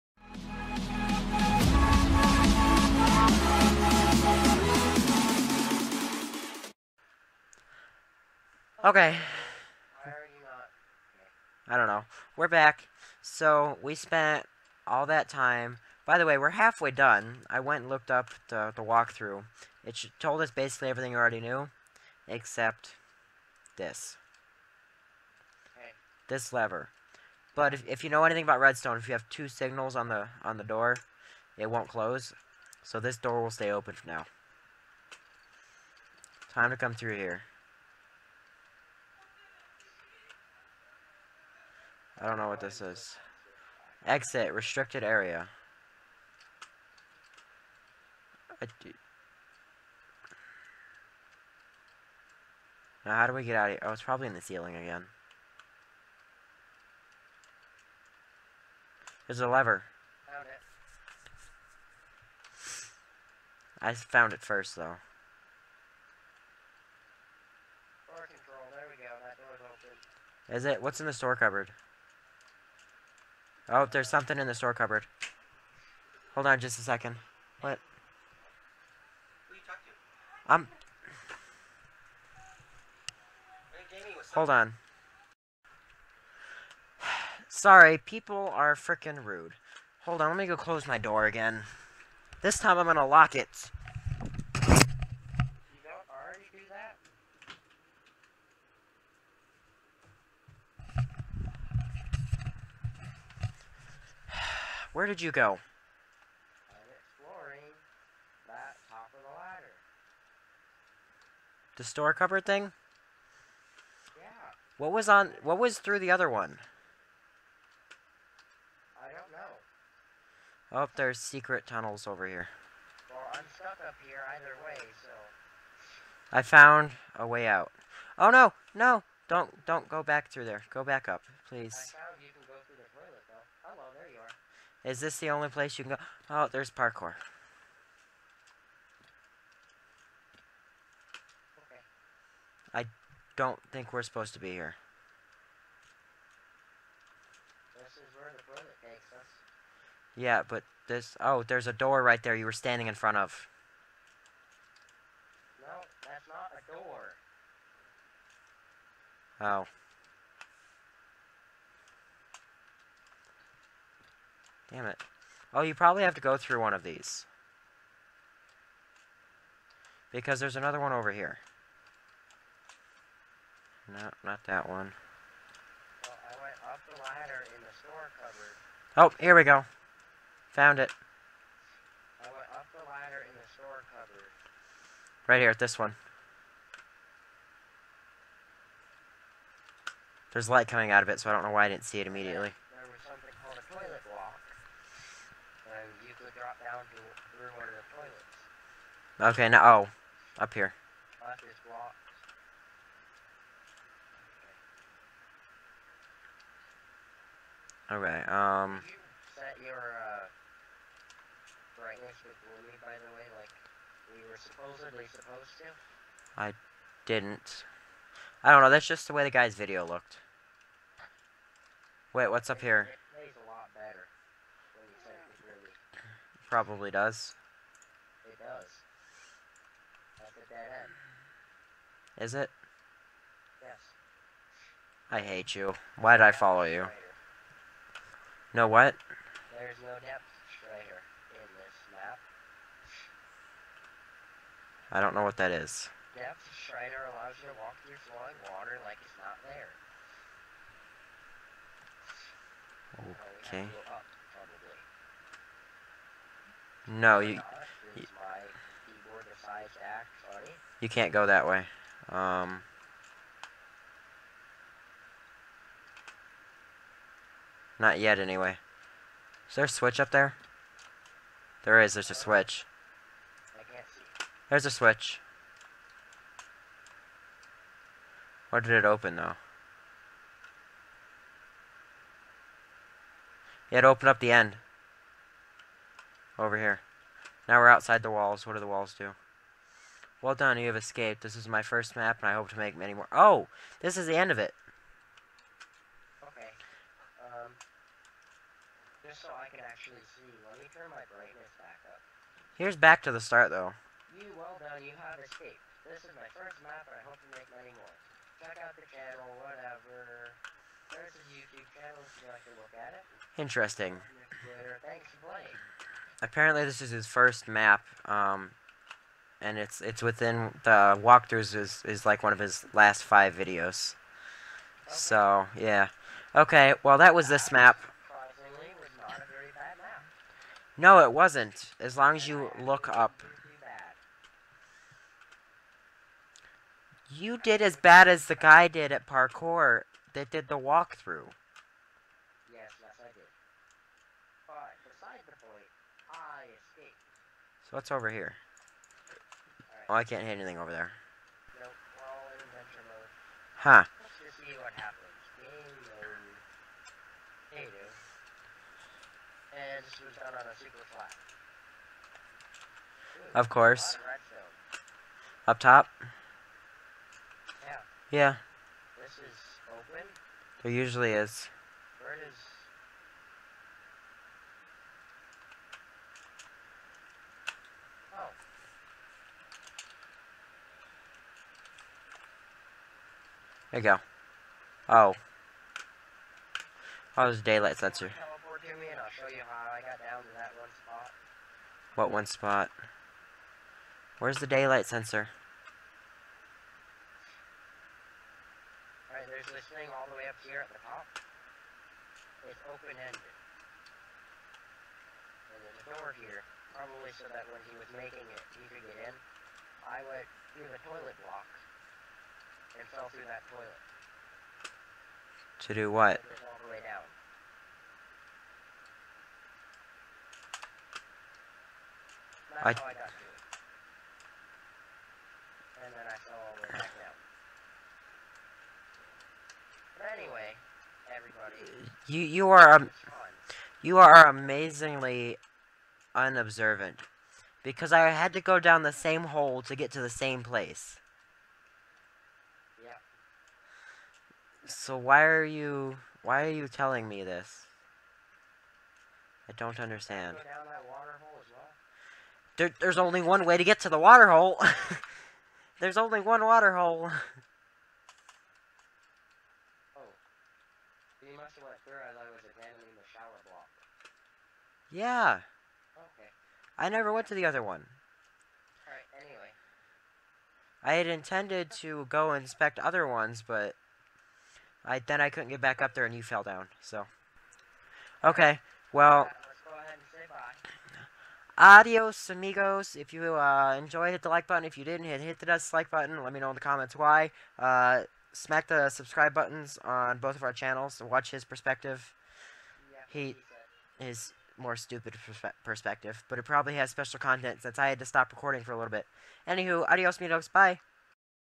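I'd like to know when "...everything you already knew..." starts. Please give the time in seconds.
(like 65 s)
20 s.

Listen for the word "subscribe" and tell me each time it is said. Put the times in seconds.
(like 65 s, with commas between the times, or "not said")
488 s.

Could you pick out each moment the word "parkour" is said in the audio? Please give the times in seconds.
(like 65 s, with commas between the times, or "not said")
136 s, 339 s.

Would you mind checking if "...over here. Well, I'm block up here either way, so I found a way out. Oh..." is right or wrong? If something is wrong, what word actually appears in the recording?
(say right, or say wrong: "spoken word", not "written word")
wrong: "stuck", not "block".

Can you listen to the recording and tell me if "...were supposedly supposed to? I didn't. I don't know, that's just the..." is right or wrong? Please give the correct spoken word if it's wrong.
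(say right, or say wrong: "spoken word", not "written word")
right.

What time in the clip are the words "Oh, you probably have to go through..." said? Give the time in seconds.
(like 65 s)
165 s.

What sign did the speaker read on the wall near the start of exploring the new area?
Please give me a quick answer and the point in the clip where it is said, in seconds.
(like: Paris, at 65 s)
Exit, restricted area, at 44 s.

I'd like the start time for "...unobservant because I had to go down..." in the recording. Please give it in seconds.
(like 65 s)
436 s.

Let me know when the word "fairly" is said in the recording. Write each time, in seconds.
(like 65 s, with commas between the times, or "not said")
not said.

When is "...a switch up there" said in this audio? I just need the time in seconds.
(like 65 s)
269 s.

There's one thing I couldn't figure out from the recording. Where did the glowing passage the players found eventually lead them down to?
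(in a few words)
The toilets.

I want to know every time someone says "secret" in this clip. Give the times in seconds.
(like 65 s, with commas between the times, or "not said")
121 s.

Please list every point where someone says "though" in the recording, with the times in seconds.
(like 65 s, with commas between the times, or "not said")
64 s, 279 s, 303 s.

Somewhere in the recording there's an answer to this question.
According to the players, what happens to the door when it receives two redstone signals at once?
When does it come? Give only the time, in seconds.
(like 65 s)
31 s.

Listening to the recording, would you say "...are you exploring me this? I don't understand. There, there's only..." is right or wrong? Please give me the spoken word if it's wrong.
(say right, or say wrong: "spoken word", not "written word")
wrong: "telling", not "exploring".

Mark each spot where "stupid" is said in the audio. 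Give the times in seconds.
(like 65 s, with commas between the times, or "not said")
494 s.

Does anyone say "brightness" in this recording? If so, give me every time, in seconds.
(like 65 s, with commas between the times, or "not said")
211 s, 301 s.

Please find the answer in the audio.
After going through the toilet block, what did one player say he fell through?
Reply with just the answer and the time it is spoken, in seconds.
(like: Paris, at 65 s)
That toilet, at 413 s.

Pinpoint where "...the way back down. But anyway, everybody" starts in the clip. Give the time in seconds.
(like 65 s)
426 s.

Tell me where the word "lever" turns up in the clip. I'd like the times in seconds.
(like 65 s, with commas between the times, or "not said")
26 s, 59 s.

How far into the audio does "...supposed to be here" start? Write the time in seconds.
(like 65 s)
144 s.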